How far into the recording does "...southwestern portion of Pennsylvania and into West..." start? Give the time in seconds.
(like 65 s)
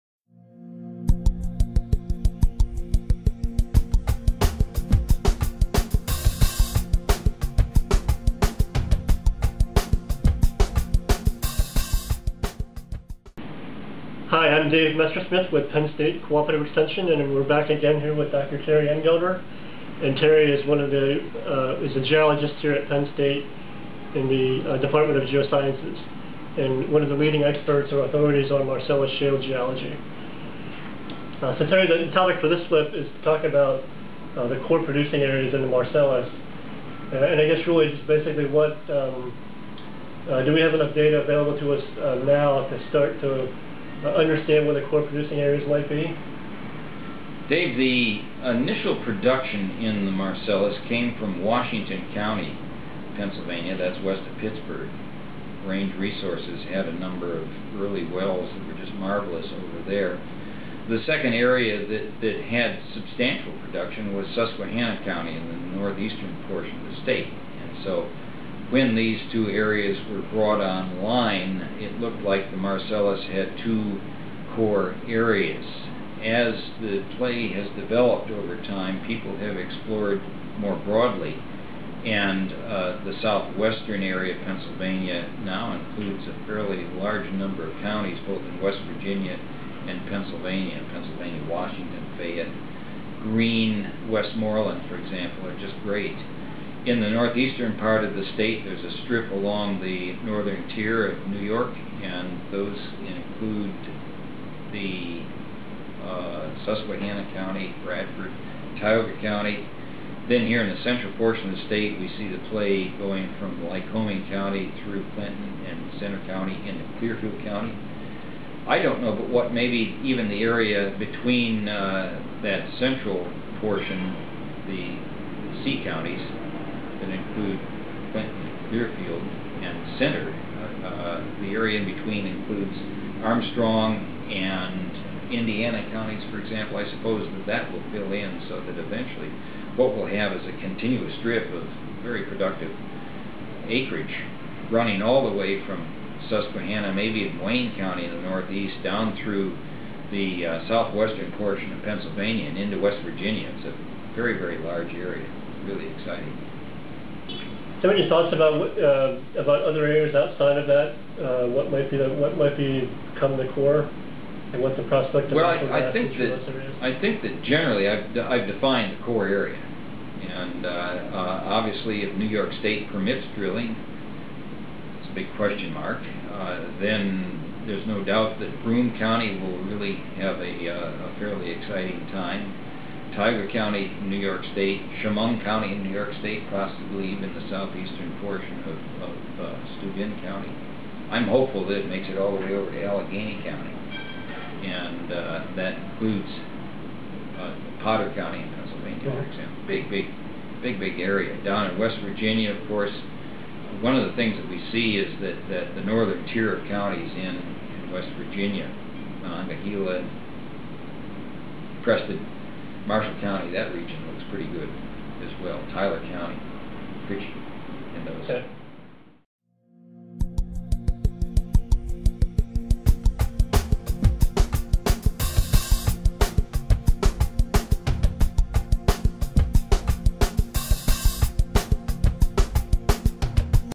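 150 s.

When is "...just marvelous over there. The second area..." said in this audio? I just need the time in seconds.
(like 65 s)
58 s.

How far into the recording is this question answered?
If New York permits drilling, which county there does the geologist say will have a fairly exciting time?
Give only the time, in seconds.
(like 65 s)
178 s.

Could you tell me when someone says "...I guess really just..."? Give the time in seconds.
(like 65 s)
37 s.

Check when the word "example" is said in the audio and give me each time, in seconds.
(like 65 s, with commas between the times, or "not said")
94 s, 136 s, 199 s.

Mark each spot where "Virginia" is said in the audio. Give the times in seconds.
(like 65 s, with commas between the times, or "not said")
88 s, 153 s, 202 s, 208 s.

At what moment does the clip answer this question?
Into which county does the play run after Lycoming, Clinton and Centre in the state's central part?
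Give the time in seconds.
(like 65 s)
116 s.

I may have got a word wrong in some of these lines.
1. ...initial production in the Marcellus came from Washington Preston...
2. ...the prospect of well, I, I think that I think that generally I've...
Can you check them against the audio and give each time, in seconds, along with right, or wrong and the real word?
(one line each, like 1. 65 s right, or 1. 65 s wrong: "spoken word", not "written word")
1. 48 s wrong: "County", not "Preston"
2. 164 s right.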